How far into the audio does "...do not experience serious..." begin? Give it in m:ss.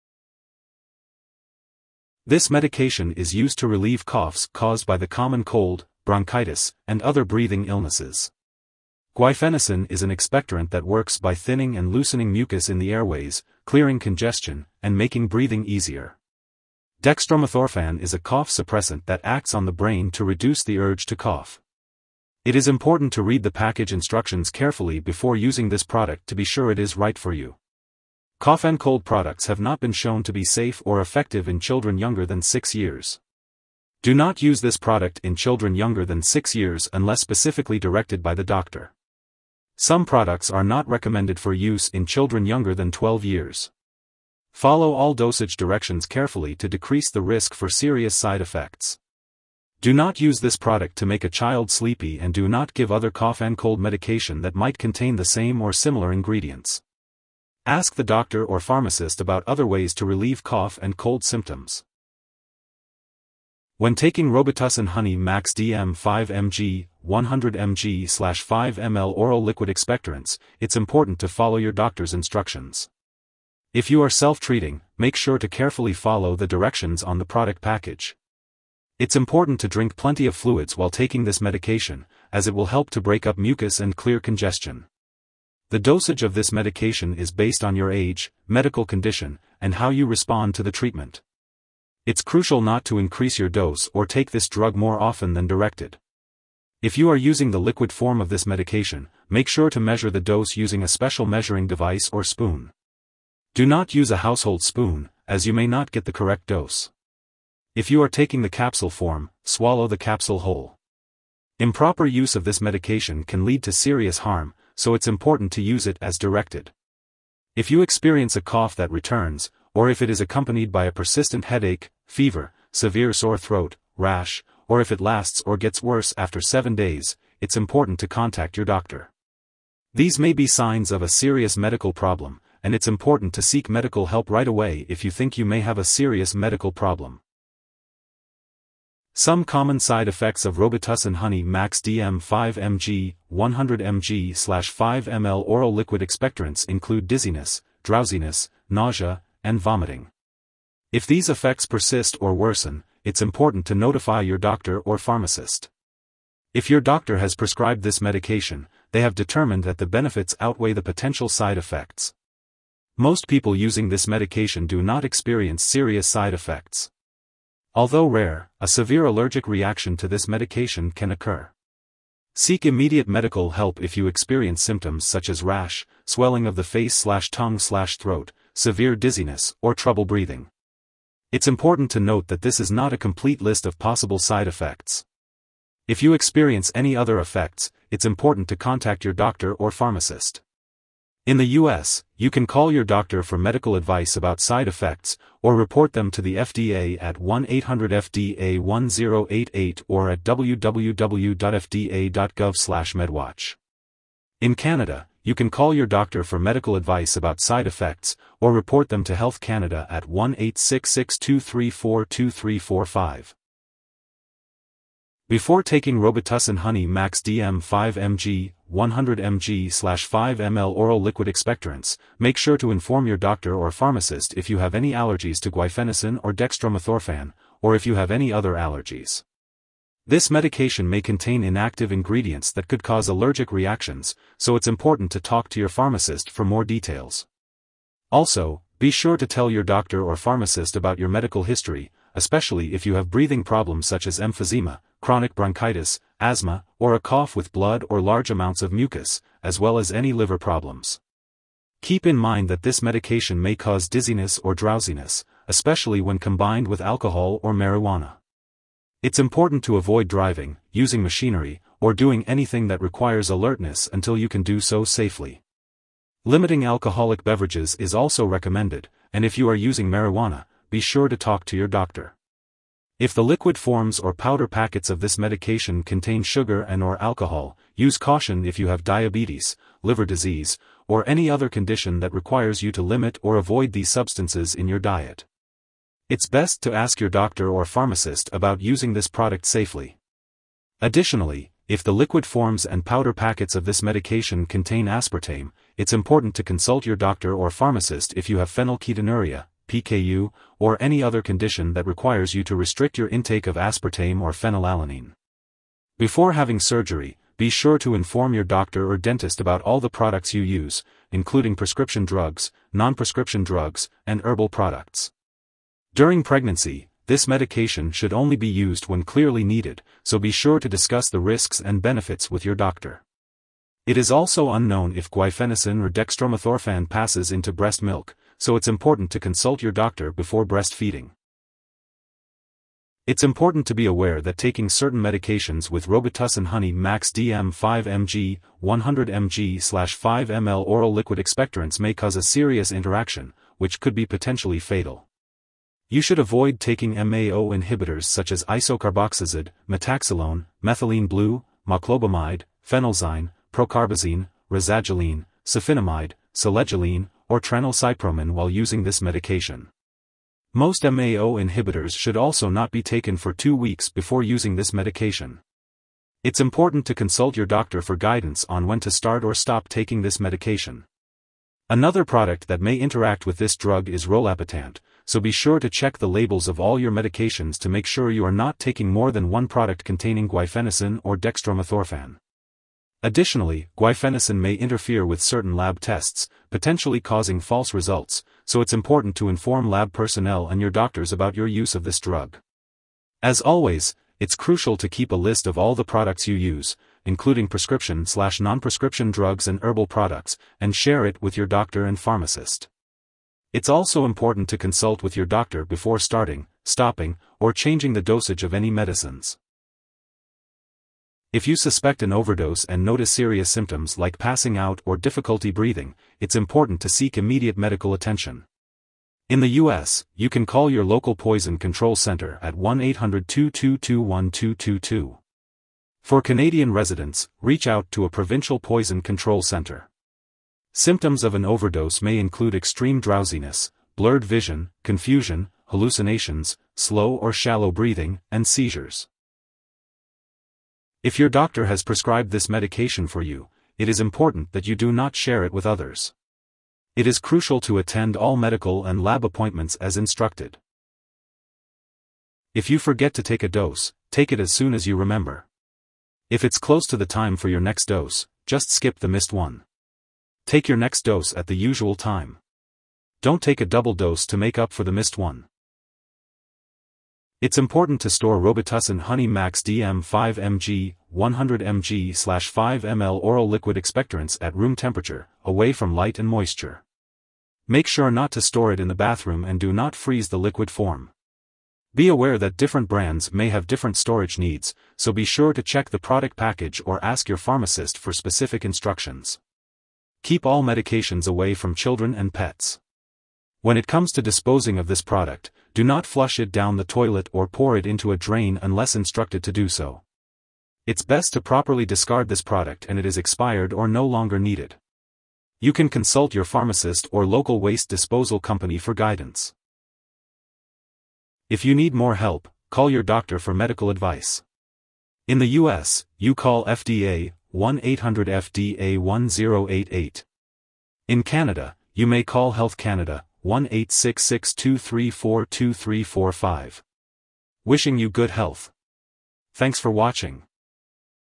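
2:44.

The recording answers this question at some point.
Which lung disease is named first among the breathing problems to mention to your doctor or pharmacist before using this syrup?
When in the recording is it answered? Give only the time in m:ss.
4:04.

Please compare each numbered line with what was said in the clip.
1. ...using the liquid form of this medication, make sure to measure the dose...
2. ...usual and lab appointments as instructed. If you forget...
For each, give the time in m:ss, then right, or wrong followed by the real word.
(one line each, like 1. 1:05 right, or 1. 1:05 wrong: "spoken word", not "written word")
1. 1:37 right
2. 7:28 wrong: "medical", not "usual".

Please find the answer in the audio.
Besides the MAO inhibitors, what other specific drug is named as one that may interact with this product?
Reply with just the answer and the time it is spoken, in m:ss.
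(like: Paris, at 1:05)
rolapitant, at 6:14.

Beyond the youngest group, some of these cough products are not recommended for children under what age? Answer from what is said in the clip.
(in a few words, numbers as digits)
12.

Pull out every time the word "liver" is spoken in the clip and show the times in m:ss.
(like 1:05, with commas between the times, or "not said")
4:10, 4:39.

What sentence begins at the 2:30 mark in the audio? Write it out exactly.
If these effects persist or worsen, it's important to notify your doctor or pharmacist.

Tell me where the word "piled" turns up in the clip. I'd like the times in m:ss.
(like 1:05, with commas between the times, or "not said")
not said.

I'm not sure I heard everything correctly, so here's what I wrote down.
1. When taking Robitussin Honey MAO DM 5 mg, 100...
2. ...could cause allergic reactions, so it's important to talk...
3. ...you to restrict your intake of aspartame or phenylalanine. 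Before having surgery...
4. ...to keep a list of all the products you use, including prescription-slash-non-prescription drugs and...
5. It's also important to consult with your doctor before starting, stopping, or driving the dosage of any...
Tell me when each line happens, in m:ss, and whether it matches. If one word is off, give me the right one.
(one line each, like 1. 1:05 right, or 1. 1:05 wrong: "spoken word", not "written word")
1. 1:03 wrong: "Max", not "MAO"
2. 3:52 right
3. 5:02 right
4. 6:34 right
5. 6:43 wrong: "changing", not "driving".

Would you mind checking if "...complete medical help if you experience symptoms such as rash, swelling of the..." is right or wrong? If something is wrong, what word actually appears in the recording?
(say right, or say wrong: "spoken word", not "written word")
wrong: "immediate", not "complete".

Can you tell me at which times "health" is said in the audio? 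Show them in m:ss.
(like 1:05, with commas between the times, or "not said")
3:29, 8:42, 8:48.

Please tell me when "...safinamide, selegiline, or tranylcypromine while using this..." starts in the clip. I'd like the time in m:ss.
5:55.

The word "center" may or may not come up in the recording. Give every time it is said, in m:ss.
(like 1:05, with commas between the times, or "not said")
7:01, 7:09.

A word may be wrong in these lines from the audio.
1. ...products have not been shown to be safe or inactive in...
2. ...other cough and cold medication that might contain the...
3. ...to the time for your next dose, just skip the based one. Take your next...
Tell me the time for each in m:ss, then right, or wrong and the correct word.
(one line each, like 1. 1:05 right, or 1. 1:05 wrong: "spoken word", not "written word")
1. 0:29 wrong: "effective", not "inactive"
2. 0:52 right
3. 7:36 wrong: "missed", not "based".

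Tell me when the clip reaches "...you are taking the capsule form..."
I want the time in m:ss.
1:47.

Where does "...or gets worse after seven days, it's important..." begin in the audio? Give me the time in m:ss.
2:05.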